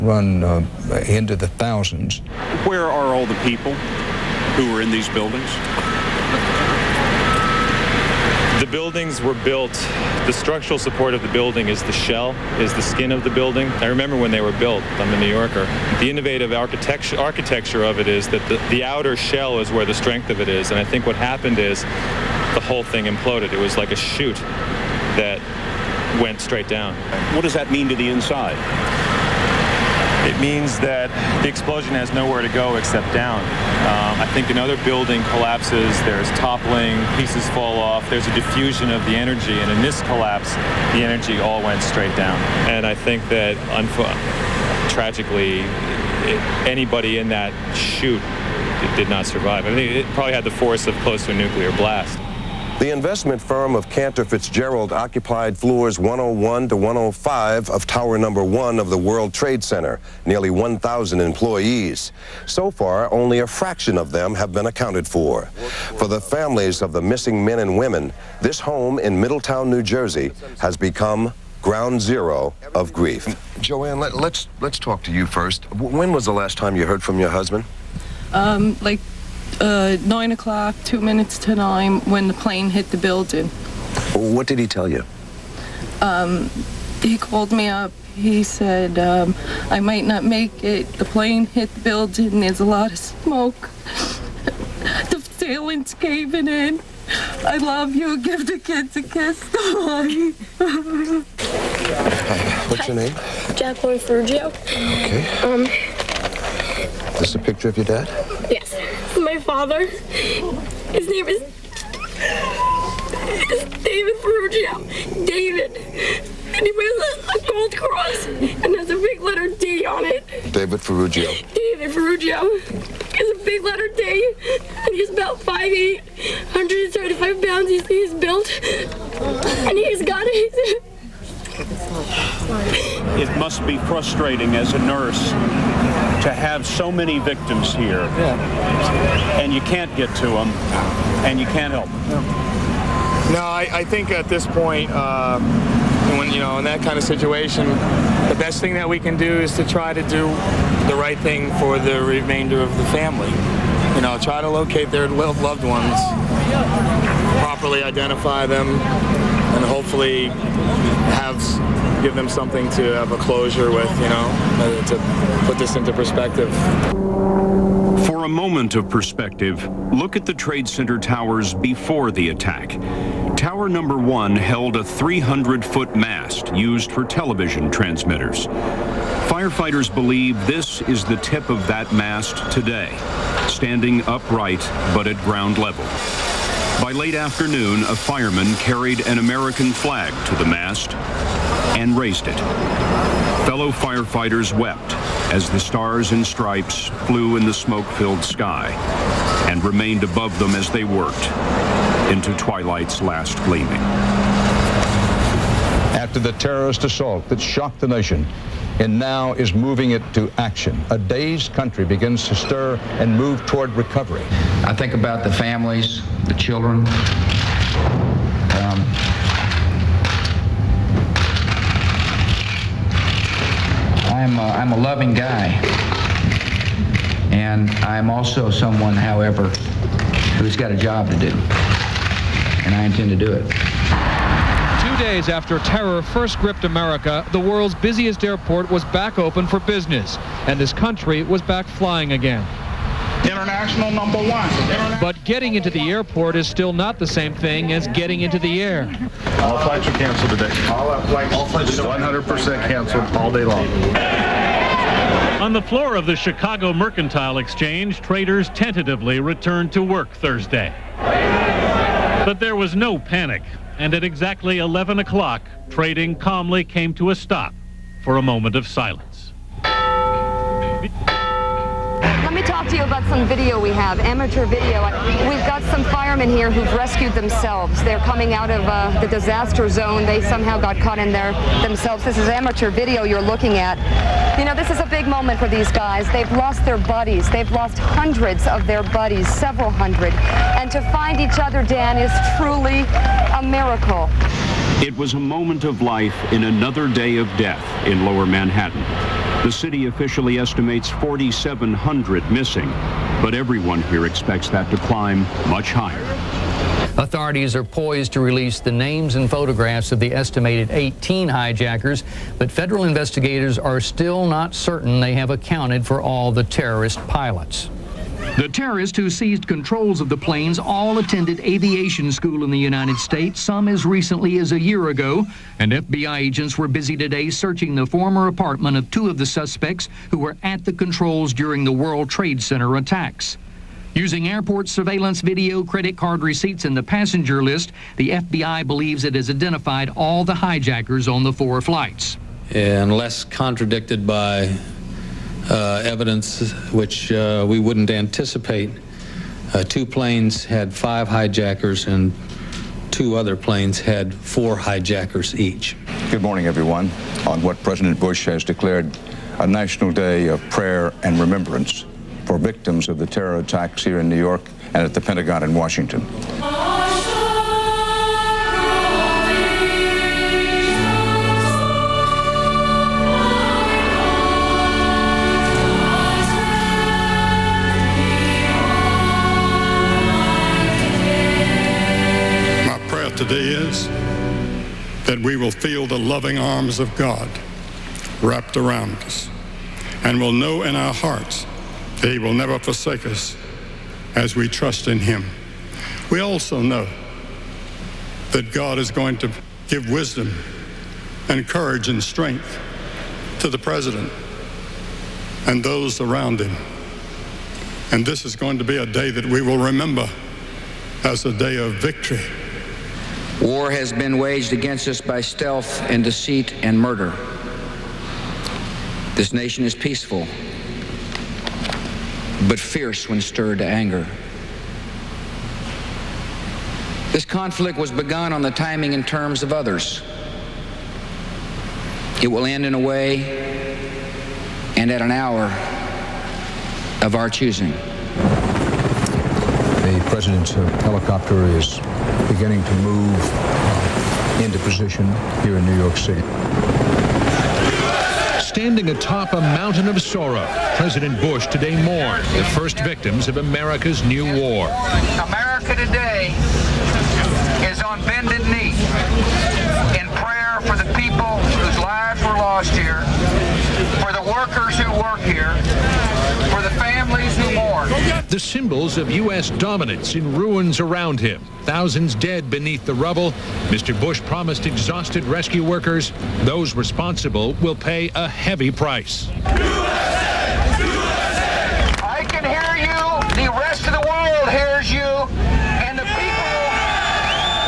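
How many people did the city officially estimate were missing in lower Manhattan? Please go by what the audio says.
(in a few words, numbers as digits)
4,700.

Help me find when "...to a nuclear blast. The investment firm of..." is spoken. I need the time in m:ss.
0:51.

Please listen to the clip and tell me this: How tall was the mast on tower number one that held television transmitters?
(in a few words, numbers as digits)
300 feet.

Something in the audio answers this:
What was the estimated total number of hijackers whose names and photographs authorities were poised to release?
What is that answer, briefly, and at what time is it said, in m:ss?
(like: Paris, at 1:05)
18, at 5:10.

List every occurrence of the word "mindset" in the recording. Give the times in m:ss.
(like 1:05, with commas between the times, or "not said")
not said.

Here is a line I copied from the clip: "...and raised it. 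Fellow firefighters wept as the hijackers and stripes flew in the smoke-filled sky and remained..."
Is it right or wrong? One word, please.
wrong.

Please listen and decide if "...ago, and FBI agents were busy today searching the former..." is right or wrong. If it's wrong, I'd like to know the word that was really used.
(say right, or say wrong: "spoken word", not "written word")
right.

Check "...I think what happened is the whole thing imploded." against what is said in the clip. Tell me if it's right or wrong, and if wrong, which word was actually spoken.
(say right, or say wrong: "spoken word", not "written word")
right.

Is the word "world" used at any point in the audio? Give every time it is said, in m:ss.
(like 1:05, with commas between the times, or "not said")
0:58, 3:57, 5:31.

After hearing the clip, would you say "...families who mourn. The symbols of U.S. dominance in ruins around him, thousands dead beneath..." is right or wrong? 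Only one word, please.
right.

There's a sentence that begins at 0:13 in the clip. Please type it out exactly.
I remember when they were built, I'm a New Yorker.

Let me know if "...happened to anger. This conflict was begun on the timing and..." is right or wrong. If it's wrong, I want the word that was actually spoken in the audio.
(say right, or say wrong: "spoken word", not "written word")
wrong: "stirred", not "happened".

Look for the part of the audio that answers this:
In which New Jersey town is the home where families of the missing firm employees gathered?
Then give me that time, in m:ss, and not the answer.
1:09.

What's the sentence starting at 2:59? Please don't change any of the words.
Firefighters believe this is the tip of that mast today, standing upright but at ground level.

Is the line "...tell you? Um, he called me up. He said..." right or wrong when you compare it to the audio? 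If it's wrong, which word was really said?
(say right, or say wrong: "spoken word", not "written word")
right.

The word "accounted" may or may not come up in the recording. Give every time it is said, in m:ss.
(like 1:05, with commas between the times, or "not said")
1:04, 5:15.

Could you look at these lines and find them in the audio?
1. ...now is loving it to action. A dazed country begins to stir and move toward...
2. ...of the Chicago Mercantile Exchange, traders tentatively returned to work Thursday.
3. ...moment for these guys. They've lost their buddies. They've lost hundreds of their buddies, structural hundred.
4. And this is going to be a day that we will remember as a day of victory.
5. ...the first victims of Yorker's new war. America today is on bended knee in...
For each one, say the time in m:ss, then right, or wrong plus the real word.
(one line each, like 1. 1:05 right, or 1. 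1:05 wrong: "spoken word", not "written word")
1. 3:28 wrong: "moving", not "loving"
2. 4:15 right
3. 4:45 wrong: "several", not "structural"
4. 6:47 right
5. 7:32 wrong: "America", not "Yorker".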